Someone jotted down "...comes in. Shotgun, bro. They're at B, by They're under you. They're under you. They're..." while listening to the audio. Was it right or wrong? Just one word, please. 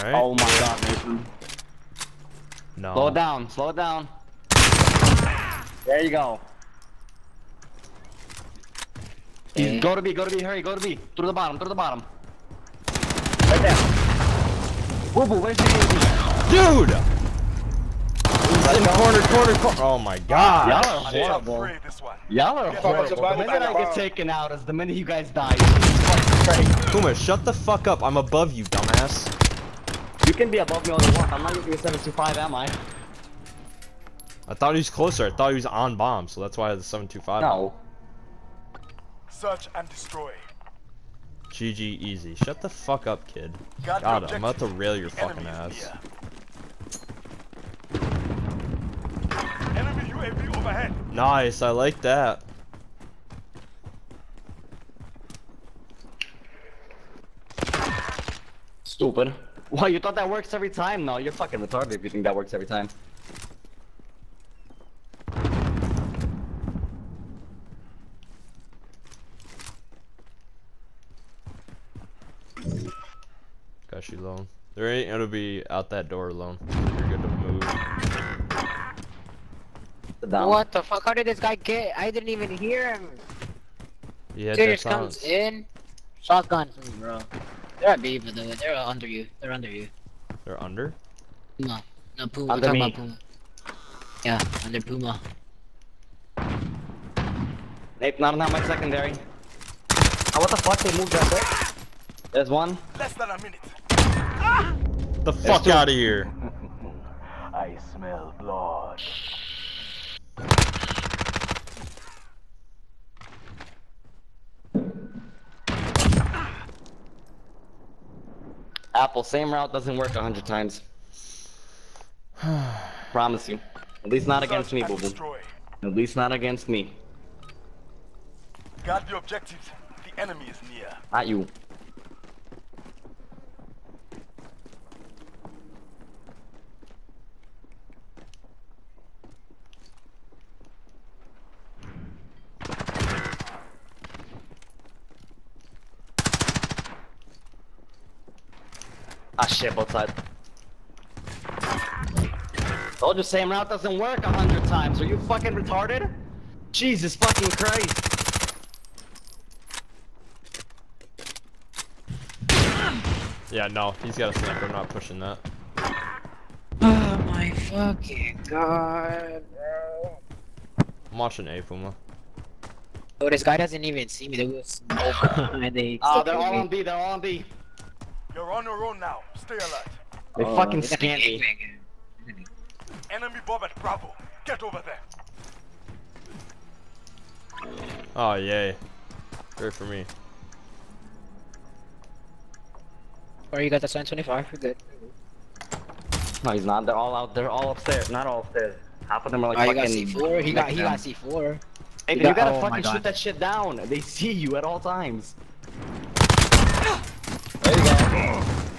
right.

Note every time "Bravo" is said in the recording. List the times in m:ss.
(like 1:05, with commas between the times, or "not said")
3:03.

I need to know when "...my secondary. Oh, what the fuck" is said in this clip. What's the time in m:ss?
1:38.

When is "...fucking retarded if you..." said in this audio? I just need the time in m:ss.
1:01.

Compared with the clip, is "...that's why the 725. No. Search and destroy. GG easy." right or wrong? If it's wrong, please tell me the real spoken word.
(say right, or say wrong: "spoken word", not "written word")
right.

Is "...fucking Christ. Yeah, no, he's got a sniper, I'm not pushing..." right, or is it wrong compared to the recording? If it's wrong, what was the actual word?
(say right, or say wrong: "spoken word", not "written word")
right.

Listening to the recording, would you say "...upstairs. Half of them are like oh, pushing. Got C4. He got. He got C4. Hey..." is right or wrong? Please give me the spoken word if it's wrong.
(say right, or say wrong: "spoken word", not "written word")
wrong: "fucking", not "pushing".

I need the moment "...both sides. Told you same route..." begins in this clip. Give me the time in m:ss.
2:29.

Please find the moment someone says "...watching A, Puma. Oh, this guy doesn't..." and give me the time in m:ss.
2:51.